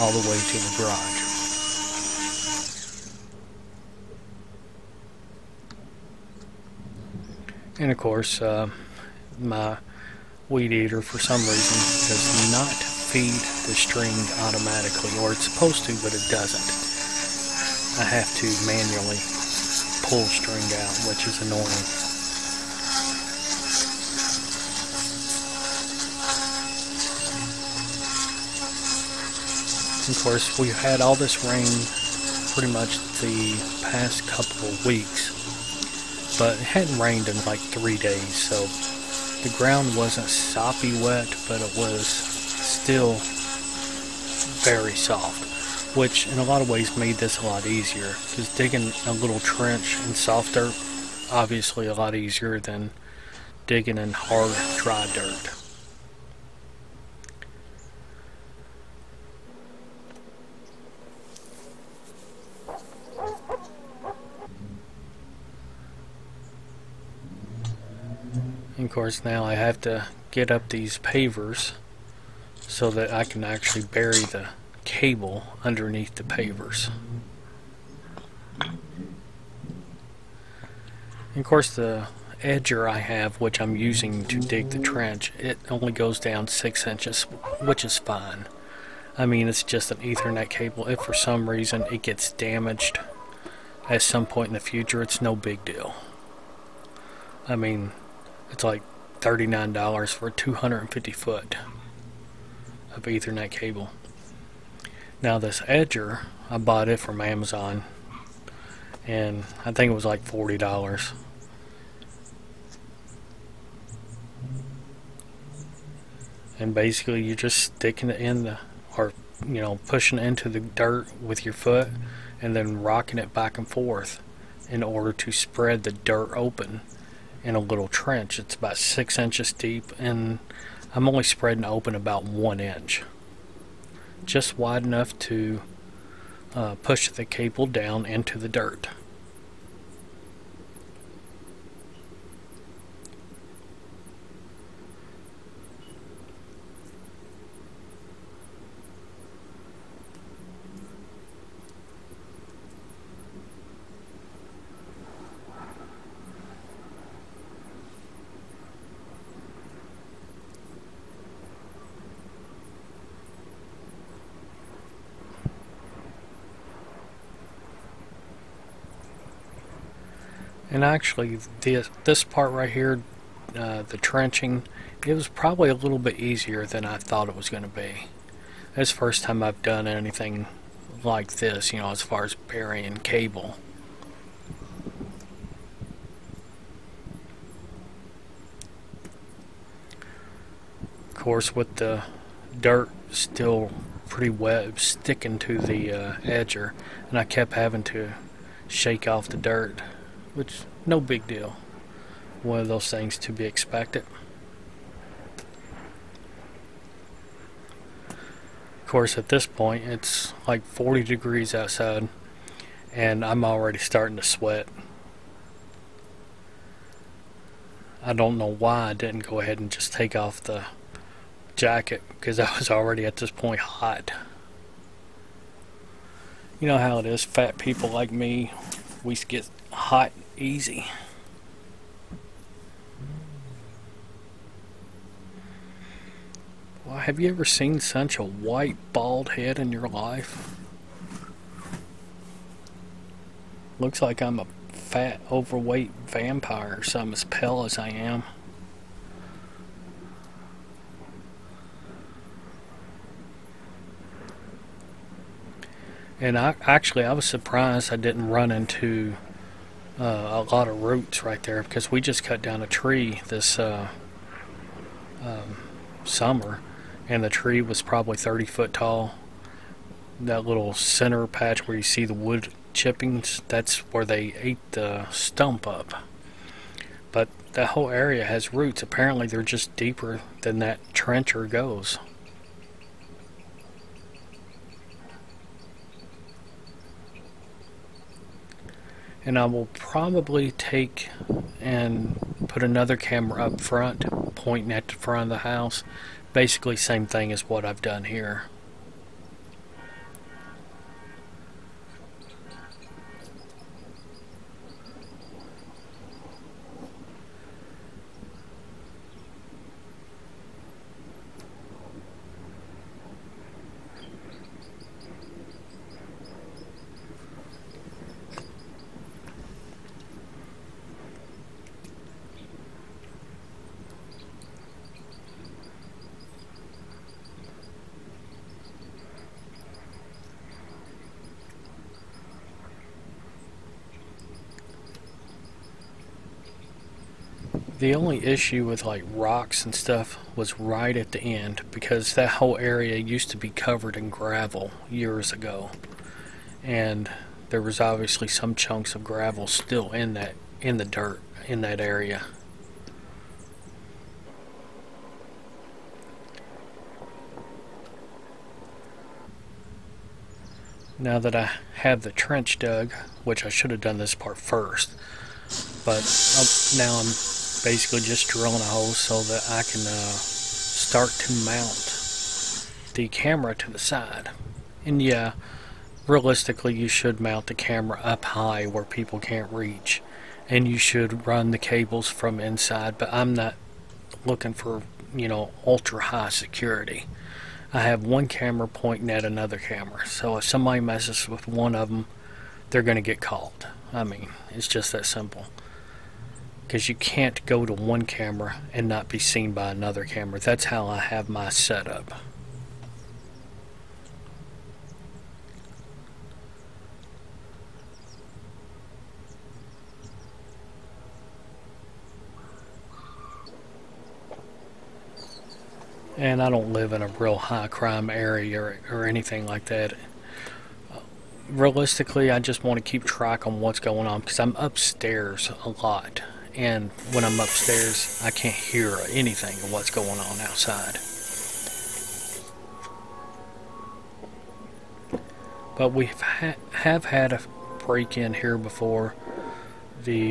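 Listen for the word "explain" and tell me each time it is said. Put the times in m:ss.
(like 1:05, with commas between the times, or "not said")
not said.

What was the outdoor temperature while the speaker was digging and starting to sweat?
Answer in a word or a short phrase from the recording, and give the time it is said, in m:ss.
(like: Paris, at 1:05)
40 degrees, at 3:30.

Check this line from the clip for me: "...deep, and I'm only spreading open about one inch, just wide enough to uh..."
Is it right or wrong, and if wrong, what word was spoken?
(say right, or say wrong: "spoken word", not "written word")
right.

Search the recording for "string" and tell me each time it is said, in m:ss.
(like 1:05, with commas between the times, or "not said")
0:13, 0:20.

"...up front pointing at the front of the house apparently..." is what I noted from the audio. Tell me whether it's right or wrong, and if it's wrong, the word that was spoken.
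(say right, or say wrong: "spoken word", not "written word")
wrong: "basically", not "apparently".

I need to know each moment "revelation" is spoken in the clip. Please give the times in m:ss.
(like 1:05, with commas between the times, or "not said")
not said.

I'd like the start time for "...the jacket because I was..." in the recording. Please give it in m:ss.
3:40.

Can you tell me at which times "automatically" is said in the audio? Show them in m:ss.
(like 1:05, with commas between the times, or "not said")
0:14.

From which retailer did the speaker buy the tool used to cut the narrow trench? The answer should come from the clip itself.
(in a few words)
Amazon.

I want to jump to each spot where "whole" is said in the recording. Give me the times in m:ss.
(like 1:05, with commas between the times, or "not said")
4:37, 5:42.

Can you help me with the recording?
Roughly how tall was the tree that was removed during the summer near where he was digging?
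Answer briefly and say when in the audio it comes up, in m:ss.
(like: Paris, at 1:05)
30 feet, at 4:28.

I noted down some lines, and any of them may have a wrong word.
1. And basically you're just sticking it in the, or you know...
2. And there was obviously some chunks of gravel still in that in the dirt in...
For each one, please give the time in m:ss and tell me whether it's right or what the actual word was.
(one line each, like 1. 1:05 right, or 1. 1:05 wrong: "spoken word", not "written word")
1. 1:56 right
2. 5:46 right.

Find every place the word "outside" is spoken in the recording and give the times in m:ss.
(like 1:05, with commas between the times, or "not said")
3:31, 7:10.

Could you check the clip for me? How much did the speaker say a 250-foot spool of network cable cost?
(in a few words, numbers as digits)
$39.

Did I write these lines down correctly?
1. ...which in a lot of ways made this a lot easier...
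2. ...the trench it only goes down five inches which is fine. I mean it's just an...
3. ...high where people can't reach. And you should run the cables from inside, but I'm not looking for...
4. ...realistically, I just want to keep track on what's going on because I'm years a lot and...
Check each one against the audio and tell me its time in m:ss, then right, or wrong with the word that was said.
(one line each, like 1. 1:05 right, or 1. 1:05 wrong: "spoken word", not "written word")
1. 0:45 right
2. 1:24 wrong: "six", not "five"
3. 6:18 right
4. 7:01 wrong: "upstairs", not "years".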